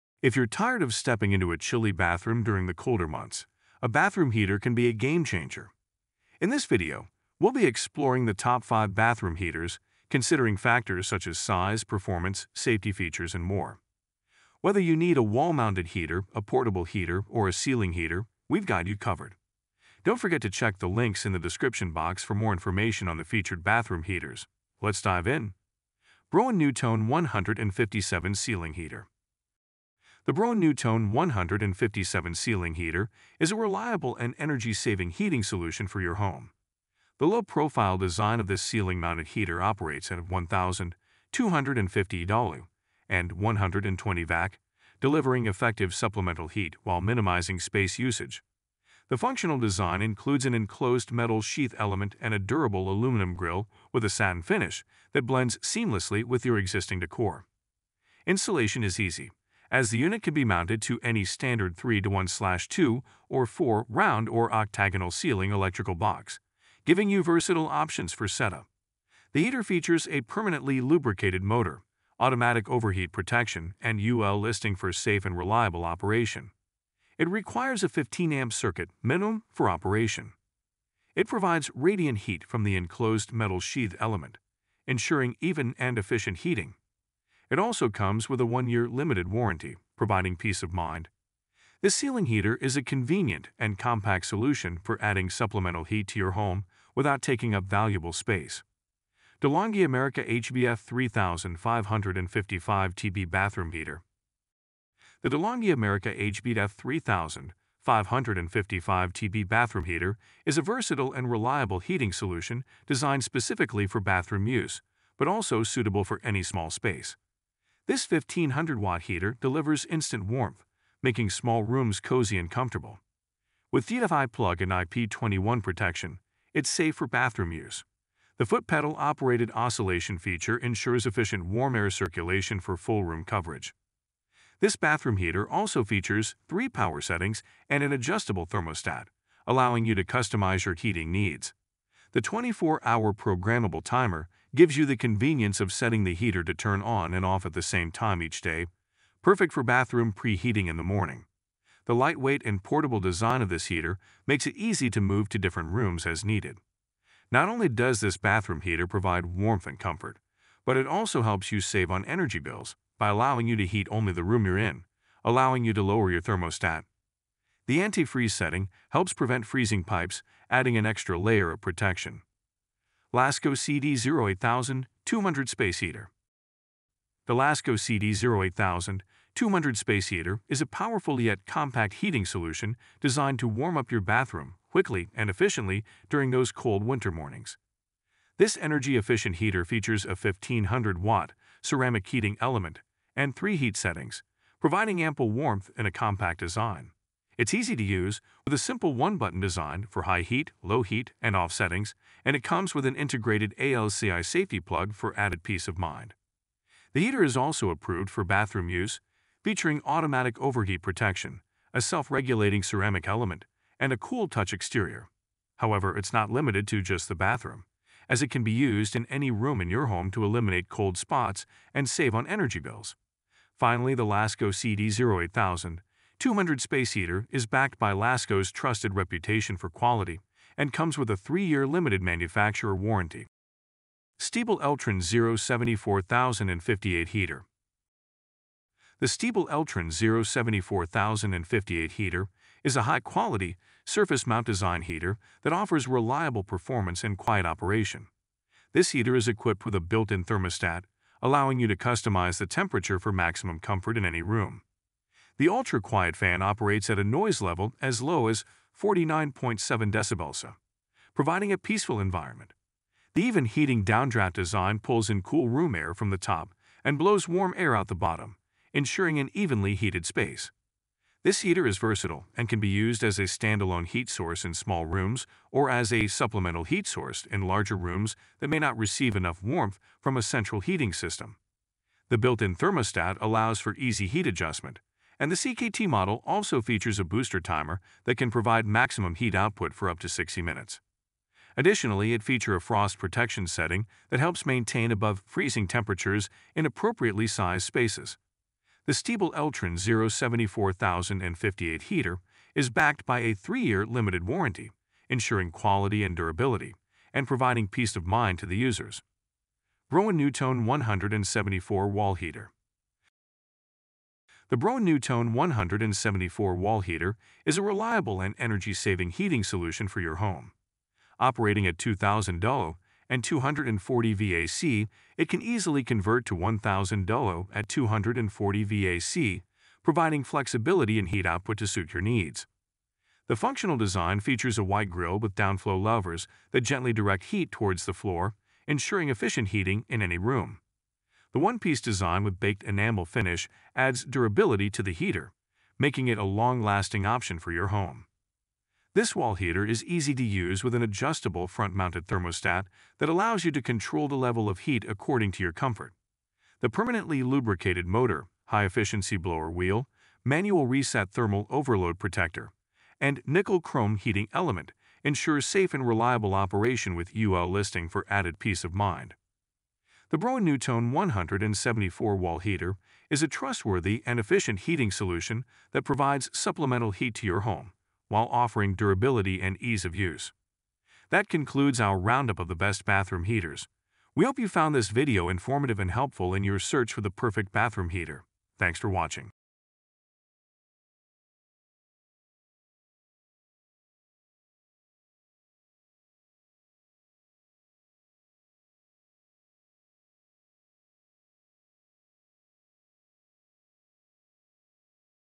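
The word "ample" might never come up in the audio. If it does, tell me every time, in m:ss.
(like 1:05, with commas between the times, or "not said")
3:15.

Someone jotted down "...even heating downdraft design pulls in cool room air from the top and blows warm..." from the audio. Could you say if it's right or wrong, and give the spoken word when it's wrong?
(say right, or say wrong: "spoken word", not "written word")
right.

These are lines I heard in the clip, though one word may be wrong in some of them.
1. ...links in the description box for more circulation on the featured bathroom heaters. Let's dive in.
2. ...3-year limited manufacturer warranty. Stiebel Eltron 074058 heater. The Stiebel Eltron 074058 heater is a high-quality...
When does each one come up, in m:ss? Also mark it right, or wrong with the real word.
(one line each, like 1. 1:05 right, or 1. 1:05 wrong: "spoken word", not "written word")
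1. 0:20 wrong: "information", not "circulation"
2. 3:51 right.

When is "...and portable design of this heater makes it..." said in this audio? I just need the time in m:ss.
2:32.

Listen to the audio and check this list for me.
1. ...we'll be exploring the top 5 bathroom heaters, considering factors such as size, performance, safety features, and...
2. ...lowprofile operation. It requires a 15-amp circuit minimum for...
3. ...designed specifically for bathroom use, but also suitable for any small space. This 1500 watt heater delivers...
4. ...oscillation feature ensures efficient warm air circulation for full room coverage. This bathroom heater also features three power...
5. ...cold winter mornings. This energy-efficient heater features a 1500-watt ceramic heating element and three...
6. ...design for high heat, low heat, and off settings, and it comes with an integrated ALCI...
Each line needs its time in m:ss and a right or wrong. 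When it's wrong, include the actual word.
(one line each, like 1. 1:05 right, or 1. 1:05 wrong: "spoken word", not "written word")
1. 0:07 right
2. 1:15 wrong: "reliable", not "lowprofile"
3. 1:52 right
4. 2:09 right
5. 3:06 right
6. 3:19 right.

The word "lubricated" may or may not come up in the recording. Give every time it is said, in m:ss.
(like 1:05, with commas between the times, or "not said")
1:10, 5:57.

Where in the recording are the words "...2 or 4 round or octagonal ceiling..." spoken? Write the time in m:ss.
1:02.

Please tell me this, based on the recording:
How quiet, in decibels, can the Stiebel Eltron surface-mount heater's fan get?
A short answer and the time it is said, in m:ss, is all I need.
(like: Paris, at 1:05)
49.7 decibels, at 4:18.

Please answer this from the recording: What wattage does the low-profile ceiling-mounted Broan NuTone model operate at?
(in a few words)
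1,250 W.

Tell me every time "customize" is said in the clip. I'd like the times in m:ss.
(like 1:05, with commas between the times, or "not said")
2:20, 4:11.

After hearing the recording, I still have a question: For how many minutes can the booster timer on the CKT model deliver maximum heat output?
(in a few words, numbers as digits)
60 minutes.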